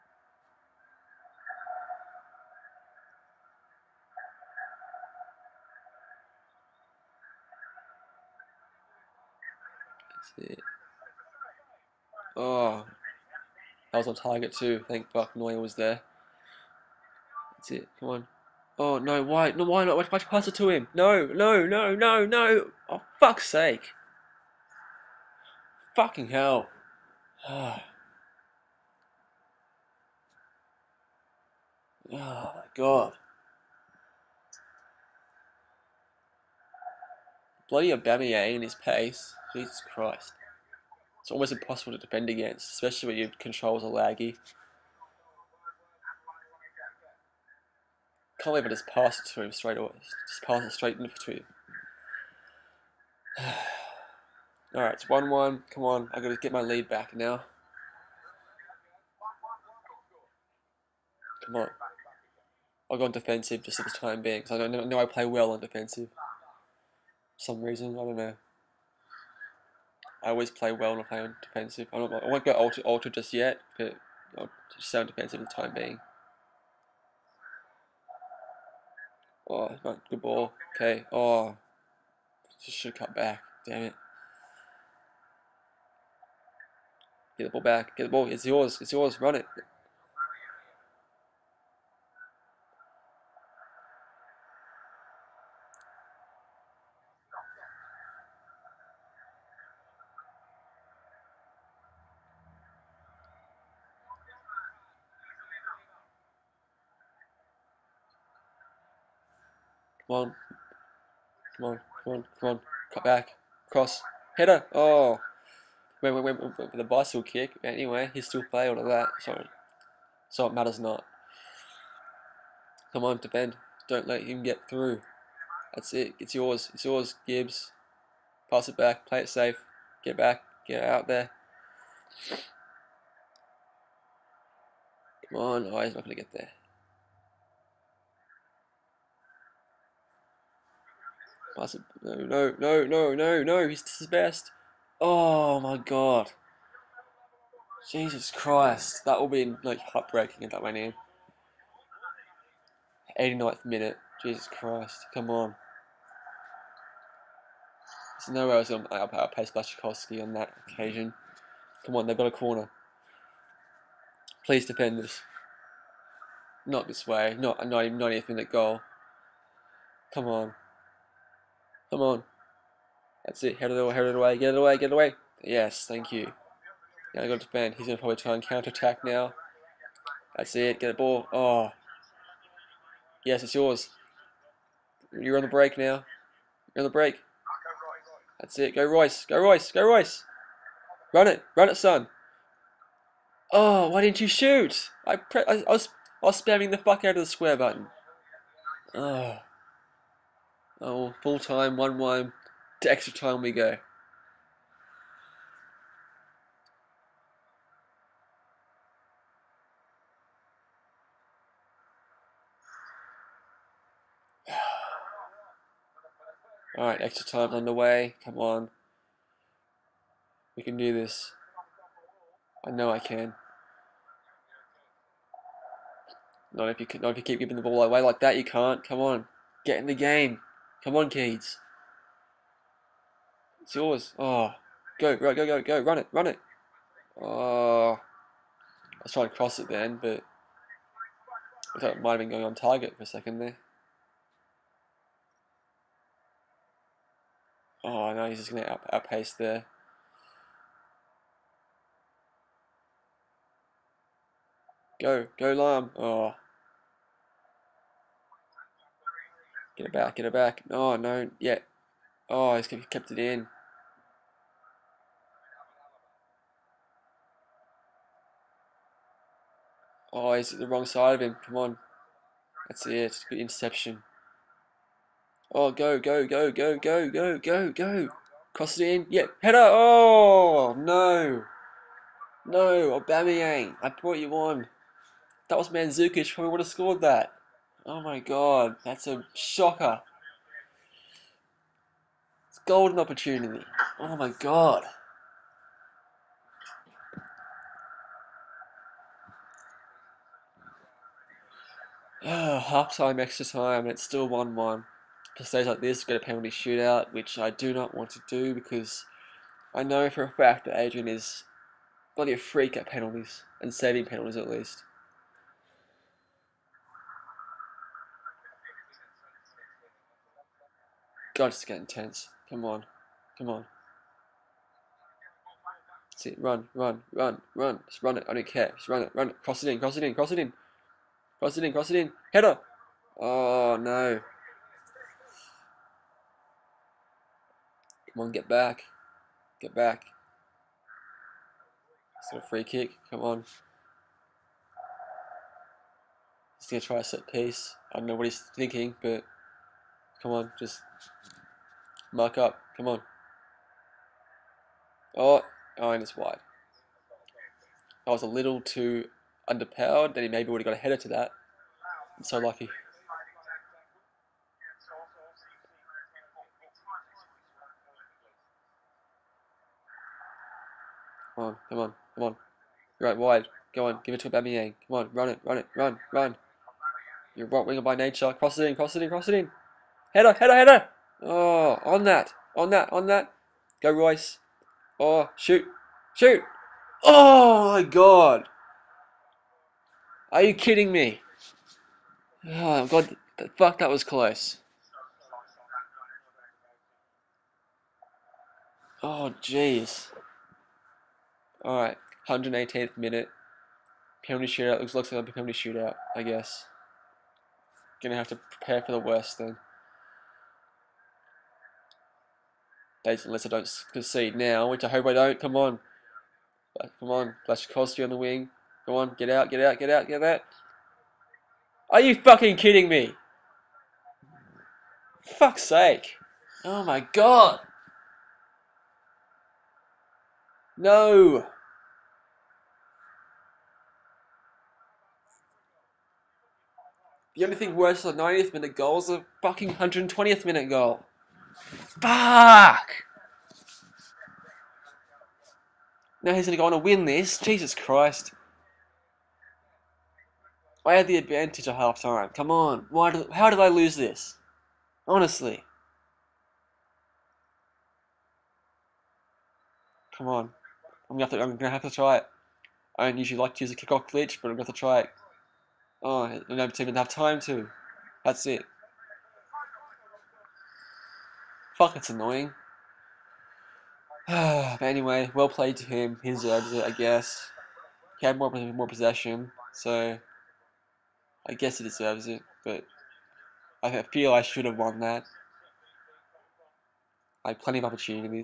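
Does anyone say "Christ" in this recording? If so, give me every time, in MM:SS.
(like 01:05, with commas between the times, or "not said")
00:39, 02:28, 02:34, 07:27.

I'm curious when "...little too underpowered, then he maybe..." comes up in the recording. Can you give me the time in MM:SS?
05:58.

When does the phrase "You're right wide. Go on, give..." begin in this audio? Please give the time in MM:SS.
06:12.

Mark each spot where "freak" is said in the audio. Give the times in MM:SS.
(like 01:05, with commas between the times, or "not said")
05:12.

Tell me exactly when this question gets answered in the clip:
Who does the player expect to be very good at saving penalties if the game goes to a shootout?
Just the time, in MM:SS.
05:10.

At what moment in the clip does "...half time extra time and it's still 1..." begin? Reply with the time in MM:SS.
05:02.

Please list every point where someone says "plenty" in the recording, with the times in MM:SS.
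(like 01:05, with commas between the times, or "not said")
08:07.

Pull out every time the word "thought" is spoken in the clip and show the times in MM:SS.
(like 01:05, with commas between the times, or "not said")
04:01.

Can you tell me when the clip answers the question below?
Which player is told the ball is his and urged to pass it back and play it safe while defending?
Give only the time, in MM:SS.
02:07.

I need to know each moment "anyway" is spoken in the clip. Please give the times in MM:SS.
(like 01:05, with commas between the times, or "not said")
01:57, 07:54.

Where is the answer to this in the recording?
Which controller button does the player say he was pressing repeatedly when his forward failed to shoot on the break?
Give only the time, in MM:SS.
03:17.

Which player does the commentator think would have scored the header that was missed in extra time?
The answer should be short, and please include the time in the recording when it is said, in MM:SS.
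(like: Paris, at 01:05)
Mandzukic, at 04:45.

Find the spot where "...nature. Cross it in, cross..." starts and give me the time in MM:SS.
06:17.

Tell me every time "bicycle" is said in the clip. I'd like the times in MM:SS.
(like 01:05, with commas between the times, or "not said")
01:56.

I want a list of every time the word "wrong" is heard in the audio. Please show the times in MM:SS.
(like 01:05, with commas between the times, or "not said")
04:30.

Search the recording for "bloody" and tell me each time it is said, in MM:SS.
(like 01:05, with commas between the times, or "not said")
00:37, 05:12.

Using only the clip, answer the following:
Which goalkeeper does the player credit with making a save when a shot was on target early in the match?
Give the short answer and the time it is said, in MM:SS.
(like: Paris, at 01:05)
Neuer, at 00:15.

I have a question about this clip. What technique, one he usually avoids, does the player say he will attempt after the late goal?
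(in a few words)
Kickoff glitch.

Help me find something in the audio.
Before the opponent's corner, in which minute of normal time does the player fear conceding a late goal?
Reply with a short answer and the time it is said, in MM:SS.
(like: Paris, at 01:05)
89th, at 02:33.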